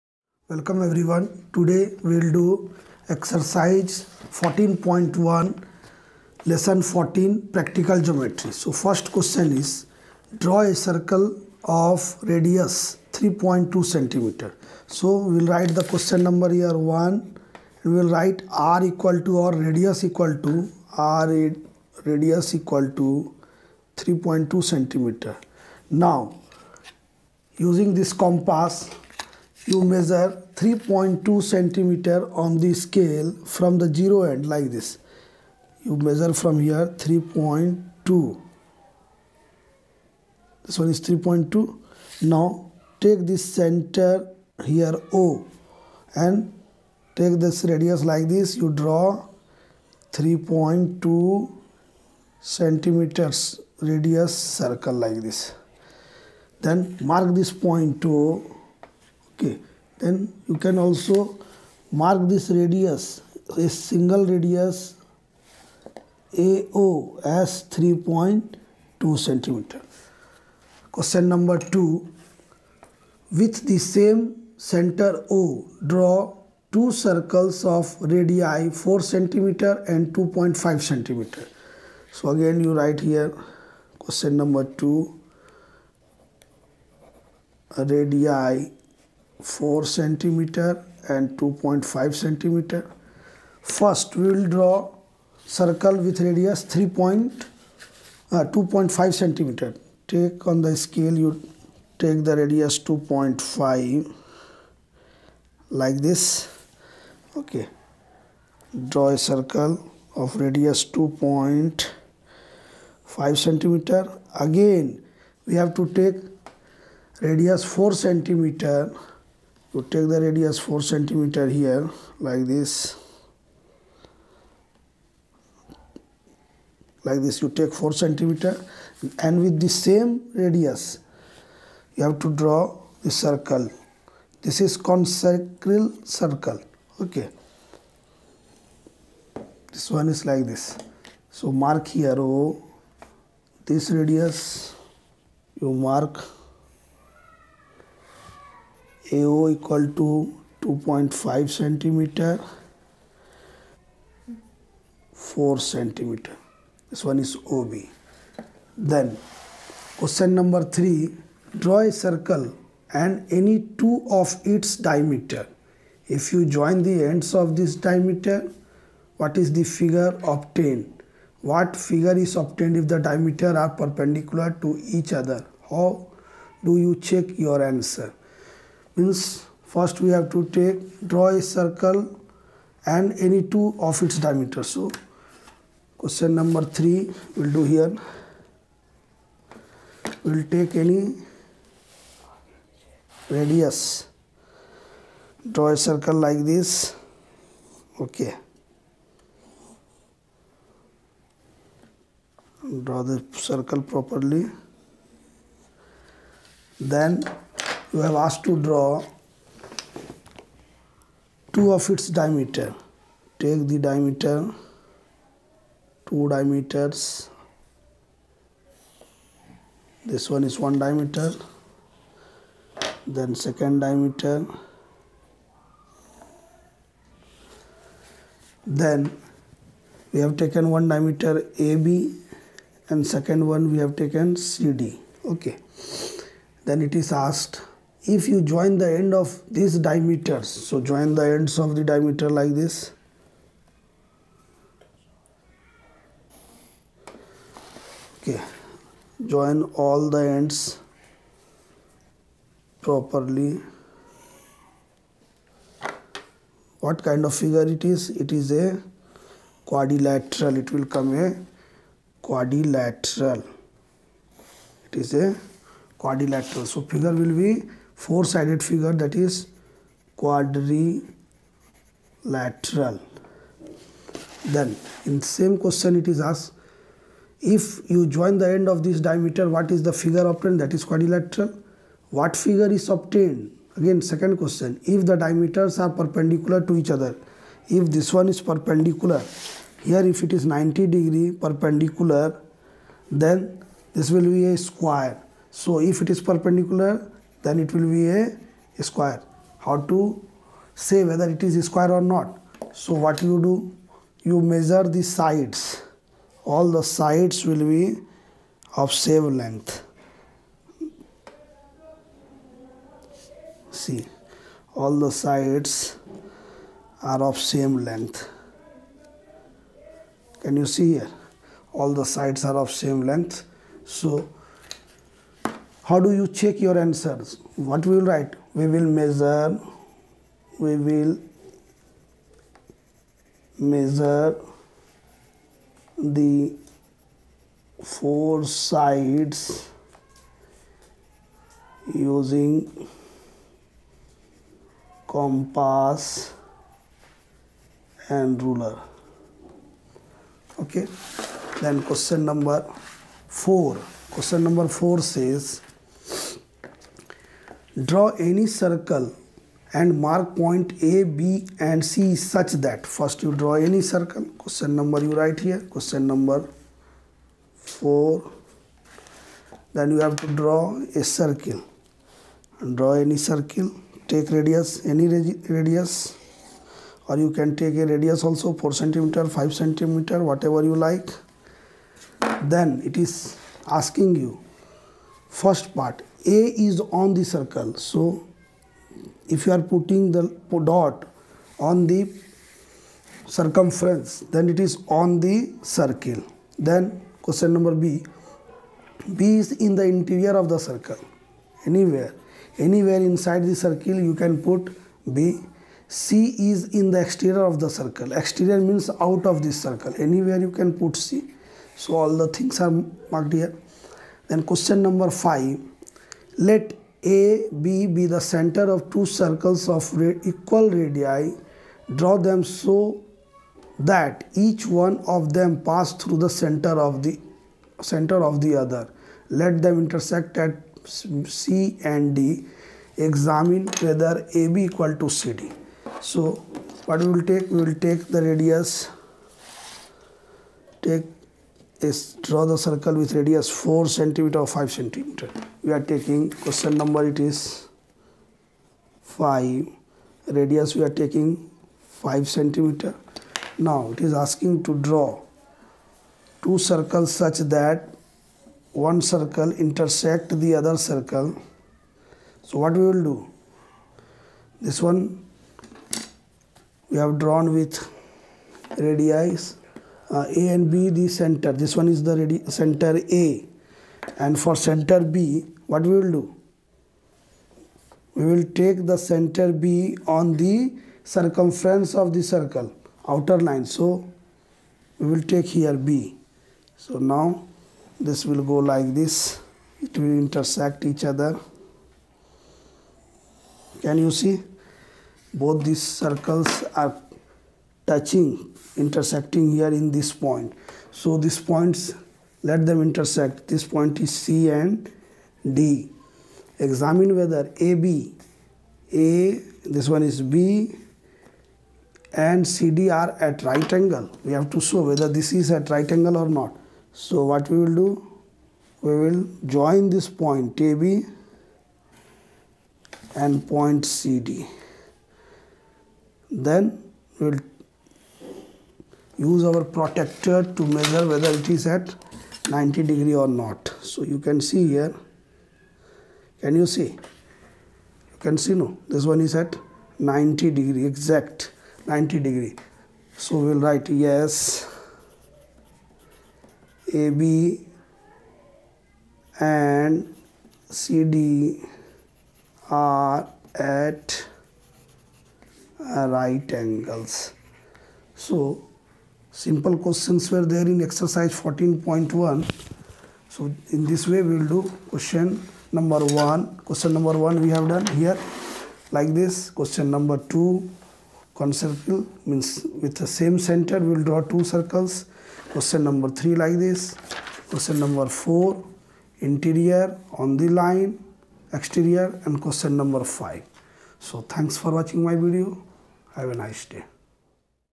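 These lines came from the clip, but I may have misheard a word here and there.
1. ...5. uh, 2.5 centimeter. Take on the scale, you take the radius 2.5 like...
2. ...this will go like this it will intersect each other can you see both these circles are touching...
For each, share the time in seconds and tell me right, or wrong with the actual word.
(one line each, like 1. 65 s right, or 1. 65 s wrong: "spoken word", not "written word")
1. 96 s wrong: "3", not "5"
2. 487 s right.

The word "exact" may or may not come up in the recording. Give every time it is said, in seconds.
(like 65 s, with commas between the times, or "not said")
540 s.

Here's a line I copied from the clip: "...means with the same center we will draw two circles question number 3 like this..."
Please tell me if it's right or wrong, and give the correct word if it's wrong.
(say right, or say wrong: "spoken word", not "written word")
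right.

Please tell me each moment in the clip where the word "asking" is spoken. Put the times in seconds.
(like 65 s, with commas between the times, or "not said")
383 s, 454 s.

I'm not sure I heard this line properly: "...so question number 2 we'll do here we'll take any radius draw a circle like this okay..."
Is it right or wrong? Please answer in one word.
wrong.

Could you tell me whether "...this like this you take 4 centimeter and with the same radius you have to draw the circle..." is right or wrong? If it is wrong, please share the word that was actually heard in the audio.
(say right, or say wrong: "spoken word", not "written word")
right.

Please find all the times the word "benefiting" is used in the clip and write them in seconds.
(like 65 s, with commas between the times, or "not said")
not said.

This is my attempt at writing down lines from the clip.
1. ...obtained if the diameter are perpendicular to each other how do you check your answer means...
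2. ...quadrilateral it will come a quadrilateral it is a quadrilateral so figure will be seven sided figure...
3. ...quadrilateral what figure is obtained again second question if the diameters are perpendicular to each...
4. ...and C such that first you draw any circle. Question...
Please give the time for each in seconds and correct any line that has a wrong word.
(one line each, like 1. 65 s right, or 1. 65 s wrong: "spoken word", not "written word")
1. 172 s right
2. 259 s wrong: "four", not "seven"
3. 280 s right
4. 361 s right.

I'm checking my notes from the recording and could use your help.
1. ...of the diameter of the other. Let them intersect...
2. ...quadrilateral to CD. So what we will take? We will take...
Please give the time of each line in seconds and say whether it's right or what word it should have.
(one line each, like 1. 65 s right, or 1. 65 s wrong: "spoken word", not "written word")
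1. 426 s wrong: "center", not "diameter"
2. 434 s wrong: "equal", not "quadrilateral".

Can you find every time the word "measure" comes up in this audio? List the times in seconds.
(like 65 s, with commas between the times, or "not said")
29 s, 35 s, 304 s, 328 s, 333 s, 530 s.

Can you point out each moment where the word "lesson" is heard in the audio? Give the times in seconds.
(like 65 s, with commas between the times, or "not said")
6 s.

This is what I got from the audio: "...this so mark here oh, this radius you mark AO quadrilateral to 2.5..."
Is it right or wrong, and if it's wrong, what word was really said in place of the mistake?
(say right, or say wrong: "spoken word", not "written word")
wrong: "equal", not "quadrilateral".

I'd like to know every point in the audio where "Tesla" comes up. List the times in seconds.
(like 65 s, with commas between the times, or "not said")
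not said.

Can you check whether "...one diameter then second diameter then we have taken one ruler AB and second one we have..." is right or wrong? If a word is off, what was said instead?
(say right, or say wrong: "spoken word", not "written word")
wrong: "diameter", not "ruler".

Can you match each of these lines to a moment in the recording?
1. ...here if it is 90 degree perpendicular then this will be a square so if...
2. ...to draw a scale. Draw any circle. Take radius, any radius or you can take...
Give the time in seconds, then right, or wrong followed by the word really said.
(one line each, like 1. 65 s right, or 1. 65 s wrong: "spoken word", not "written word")
1. 289 s right
2. 370 s wrong: "circle", not "scale".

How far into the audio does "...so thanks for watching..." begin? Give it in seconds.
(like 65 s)
583 s.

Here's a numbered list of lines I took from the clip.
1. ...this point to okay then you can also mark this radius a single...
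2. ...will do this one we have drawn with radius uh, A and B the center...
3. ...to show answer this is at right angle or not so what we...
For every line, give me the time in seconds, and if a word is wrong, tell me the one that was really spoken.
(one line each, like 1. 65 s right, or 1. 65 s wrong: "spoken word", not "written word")
1. 57 s right
2. 462 s right
3. 514 s wrong: "whether", not "answer".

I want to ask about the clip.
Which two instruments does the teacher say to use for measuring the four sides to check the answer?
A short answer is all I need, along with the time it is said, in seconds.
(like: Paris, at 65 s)
compass and ruler, at 345 s.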